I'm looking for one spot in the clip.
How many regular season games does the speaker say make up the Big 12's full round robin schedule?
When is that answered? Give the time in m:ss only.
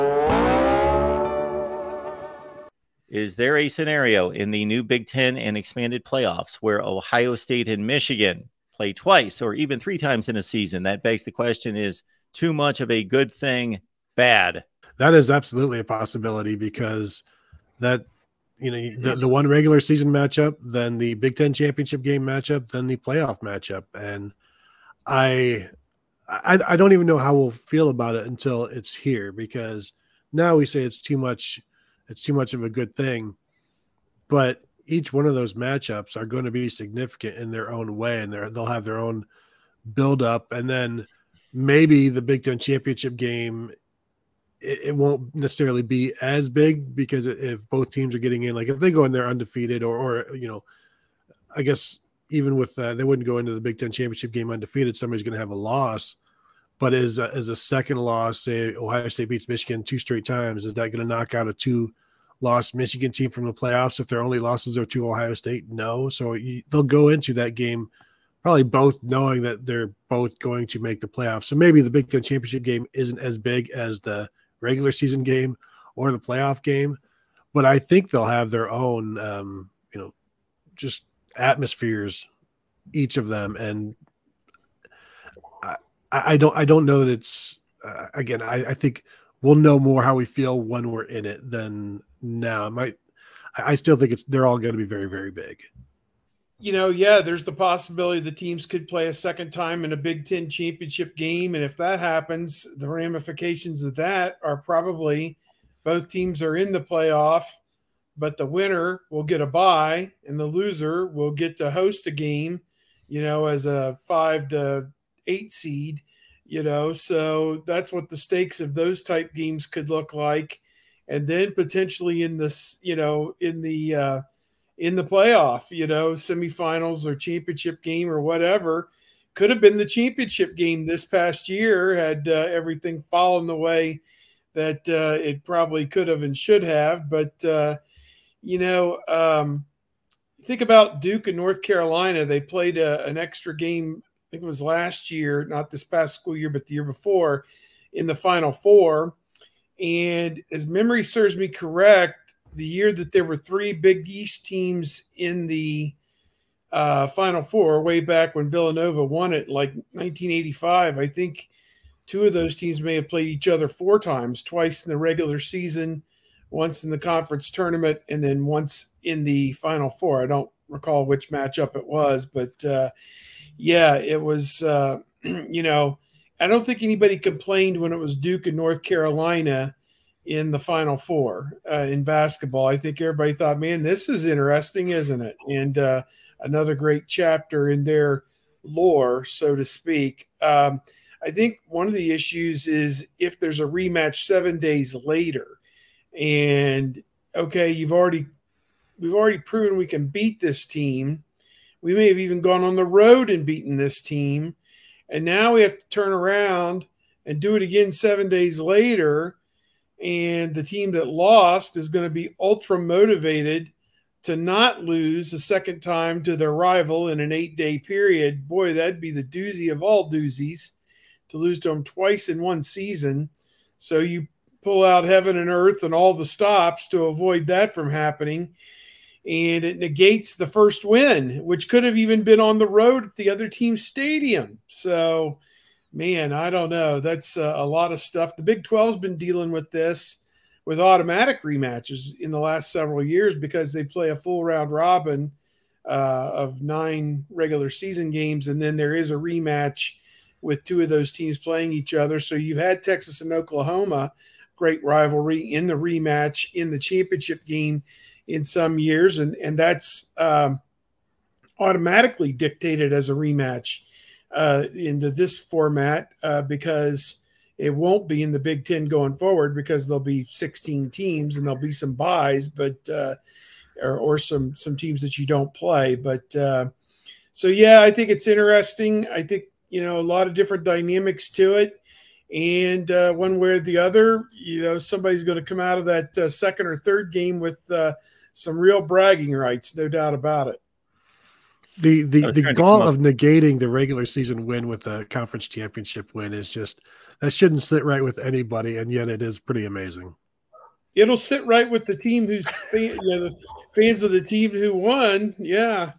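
4:06.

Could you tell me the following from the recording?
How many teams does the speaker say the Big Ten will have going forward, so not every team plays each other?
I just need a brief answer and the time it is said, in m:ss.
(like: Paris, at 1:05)
16, at 4:30.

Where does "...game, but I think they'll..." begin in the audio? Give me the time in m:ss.
1:16.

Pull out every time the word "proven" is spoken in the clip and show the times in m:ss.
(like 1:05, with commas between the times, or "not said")
3:19.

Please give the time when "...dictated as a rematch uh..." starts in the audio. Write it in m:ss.
4:22.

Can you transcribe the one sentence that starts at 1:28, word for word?
I, I think we'll know more how we feel when we're in it than now.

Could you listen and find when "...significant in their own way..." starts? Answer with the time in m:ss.
0:36.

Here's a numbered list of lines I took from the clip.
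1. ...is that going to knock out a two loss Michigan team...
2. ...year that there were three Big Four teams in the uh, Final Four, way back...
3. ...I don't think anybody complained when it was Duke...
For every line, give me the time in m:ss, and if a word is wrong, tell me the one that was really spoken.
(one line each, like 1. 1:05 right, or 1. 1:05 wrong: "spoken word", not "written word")
1. 1:00 right
2. 2:32 wrong: "East", not "Four"
3. 2:56 right.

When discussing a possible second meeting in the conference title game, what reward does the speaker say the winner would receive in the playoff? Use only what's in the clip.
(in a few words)
a bye.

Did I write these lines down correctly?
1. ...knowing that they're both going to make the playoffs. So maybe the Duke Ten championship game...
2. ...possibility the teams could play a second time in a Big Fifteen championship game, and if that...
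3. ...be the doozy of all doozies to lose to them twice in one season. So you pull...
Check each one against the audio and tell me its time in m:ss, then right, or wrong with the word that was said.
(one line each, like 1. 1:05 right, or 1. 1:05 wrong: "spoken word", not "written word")
1. 1:09 wrong: "Big", not "Duke"
2. 1:37 wrong: "Ten", not "Fifteen"
3. 3:39 right.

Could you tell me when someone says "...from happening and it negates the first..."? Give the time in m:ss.
3:47.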